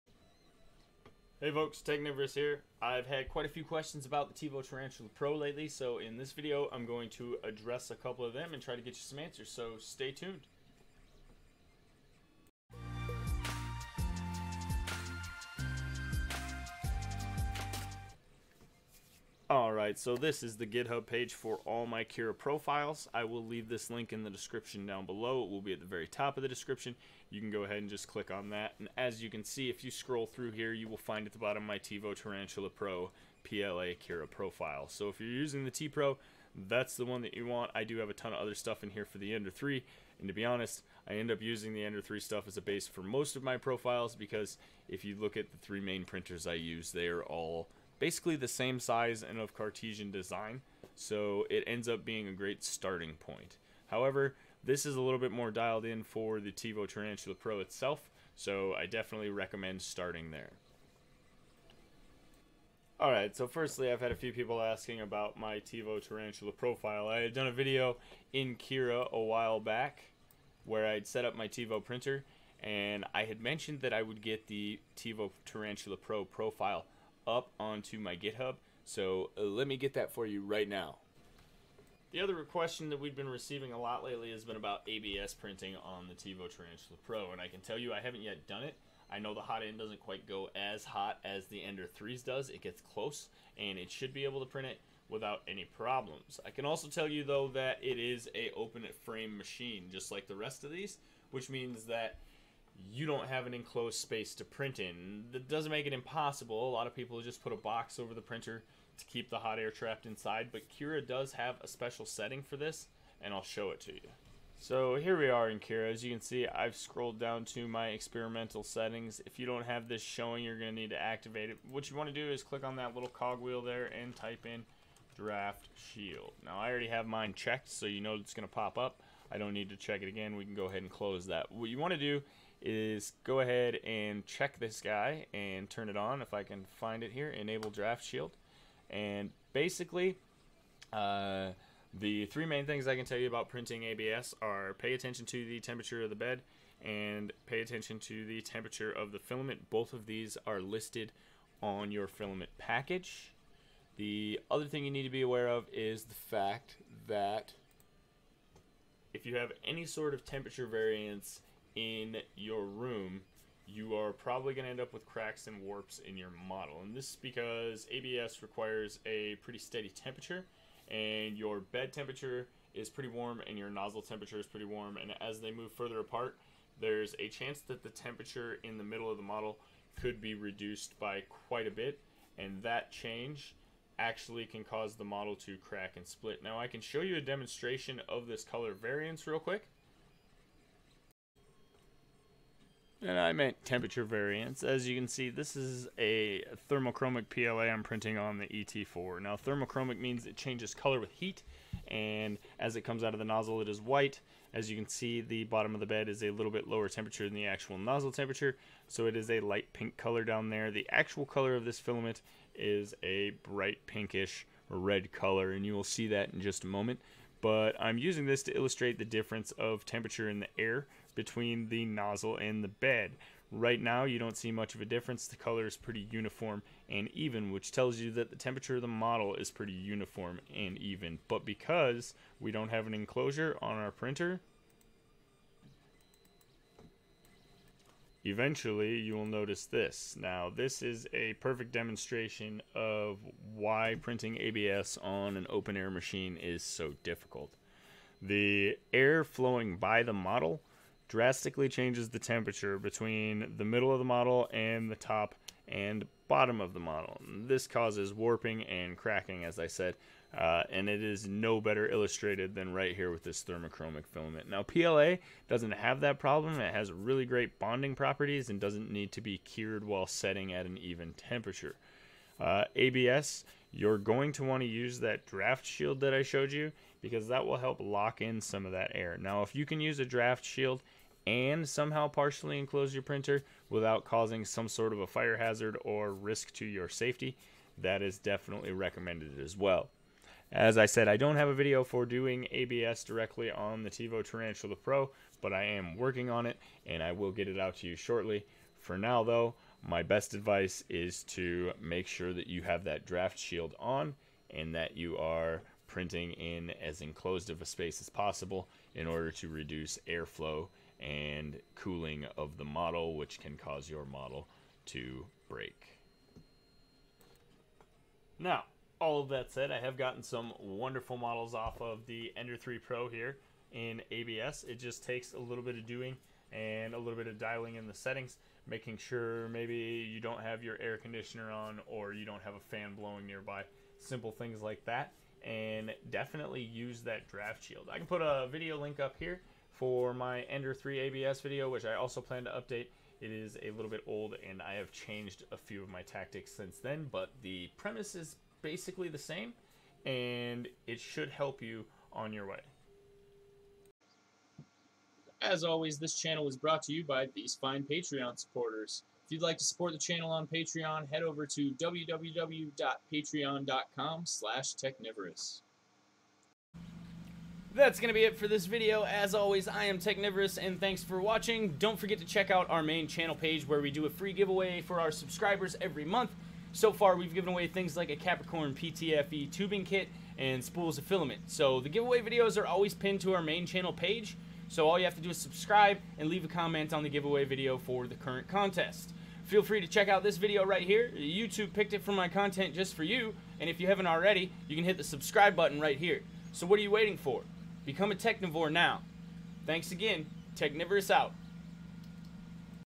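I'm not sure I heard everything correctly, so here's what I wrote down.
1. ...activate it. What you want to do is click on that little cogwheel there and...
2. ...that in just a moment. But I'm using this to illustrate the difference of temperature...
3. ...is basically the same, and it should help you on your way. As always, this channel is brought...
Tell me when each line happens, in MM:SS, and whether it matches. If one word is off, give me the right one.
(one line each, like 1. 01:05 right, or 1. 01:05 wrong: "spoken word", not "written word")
1. 02:01 right
2. 03:36 right
3. 05:48 right.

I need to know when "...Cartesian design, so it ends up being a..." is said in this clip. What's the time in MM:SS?
00:49.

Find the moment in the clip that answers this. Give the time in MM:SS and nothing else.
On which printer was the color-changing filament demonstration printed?
03:18.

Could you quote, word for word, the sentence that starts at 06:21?
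So the giveaway videos are always pinned to our main channel page.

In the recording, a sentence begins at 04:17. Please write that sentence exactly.
This causes warping and cracking, as I said, uh, and it is no better illustrated than right here with this thermochromic filament.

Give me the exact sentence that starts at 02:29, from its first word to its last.
Both of these are listed on your filament package.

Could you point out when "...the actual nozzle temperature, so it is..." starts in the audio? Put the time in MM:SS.
03:27.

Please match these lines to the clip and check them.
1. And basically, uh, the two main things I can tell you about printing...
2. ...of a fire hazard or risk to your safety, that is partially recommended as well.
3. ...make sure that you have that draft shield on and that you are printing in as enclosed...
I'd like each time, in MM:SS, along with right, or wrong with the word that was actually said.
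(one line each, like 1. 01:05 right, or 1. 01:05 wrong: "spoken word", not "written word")
1. 02:18 wrong: "three", not "two"
2. 04:44 wrong: "definitely", not "partially"
3. 05:01 right.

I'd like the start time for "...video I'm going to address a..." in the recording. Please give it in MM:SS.
00:06.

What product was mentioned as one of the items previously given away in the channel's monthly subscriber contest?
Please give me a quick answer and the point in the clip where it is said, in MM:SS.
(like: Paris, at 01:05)
Capricorn PTFE tubing kit, at 06:18.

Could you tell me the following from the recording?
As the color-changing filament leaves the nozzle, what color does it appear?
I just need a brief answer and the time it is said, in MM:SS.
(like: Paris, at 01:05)
White, at 03:23.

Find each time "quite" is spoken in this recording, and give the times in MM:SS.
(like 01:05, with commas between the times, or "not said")
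00:03, 01:30, 03:01.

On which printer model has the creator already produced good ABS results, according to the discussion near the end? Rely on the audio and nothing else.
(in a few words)
Ender 3 Pro.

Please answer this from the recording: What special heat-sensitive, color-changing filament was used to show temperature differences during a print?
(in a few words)
Thermochromic PLA.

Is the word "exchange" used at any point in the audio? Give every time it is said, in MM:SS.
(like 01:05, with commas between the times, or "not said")
not said.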